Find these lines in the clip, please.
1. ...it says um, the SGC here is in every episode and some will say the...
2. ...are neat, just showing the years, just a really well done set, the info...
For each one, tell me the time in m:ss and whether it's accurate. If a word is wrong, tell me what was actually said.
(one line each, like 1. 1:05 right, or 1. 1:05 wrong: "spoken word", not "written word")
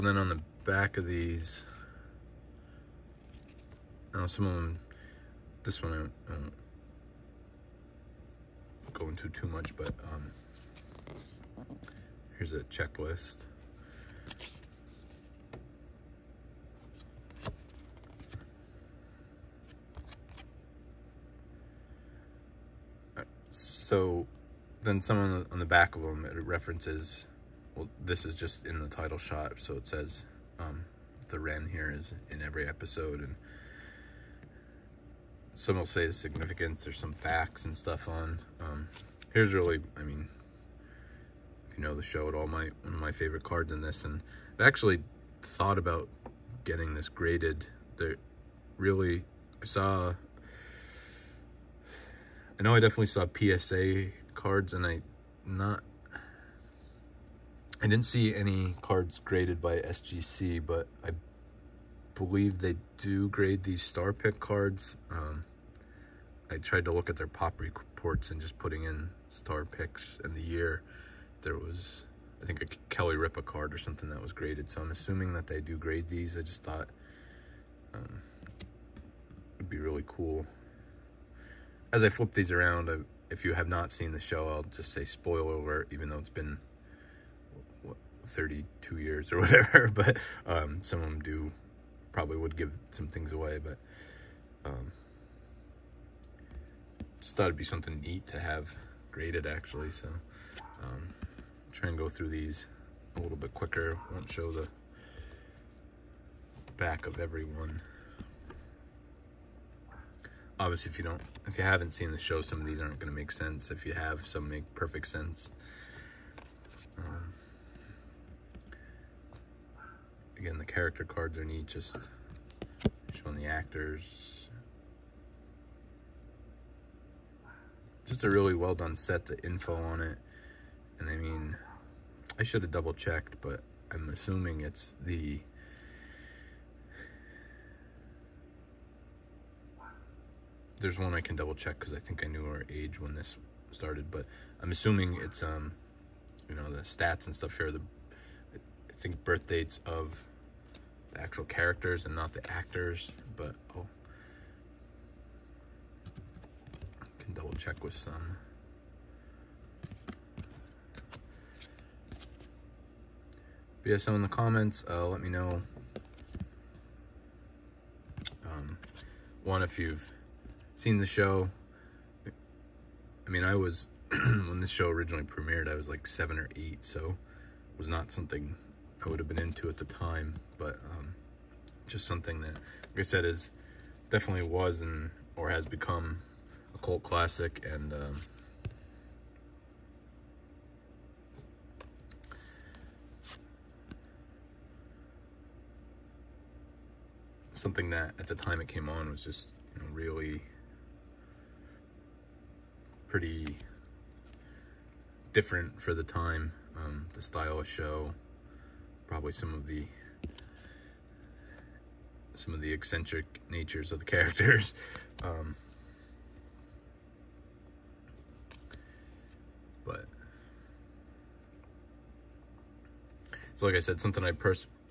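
1. 0:29 wrong: "Wren", not "SGC"
2. 2:01 wrong: "actors", not "years".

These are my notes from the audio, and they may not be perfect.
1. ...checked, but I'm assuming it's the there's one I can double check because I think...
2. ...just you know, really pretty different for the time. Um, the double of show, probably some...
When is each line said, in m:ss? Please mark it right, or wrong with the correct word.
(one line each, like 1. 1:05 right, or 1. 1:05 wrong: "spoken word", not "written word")
1. 2:12 right
2. 3:19 wrong: "style", not "double".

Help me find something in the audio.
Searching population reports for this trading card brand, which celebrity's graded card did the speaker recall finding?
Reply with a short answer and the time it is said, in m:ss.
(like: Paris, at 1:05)
Kelly Ripa, at 1:12.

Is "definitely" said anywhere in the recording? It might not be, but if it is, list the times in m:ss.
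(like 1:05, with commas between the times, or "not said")
0:52, 3:04.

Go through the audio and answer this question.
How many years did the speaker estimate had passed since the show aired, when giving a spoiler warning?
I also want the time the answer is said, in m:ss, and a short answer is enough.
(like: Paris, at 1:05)
32, at 1:28.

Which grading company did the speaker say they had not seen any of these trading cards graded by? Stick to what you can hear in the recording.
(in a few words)
SGC.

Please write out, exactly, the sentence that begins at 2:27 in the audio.
The I think birth dates of the actual characters and not the actors, but oh, check with some.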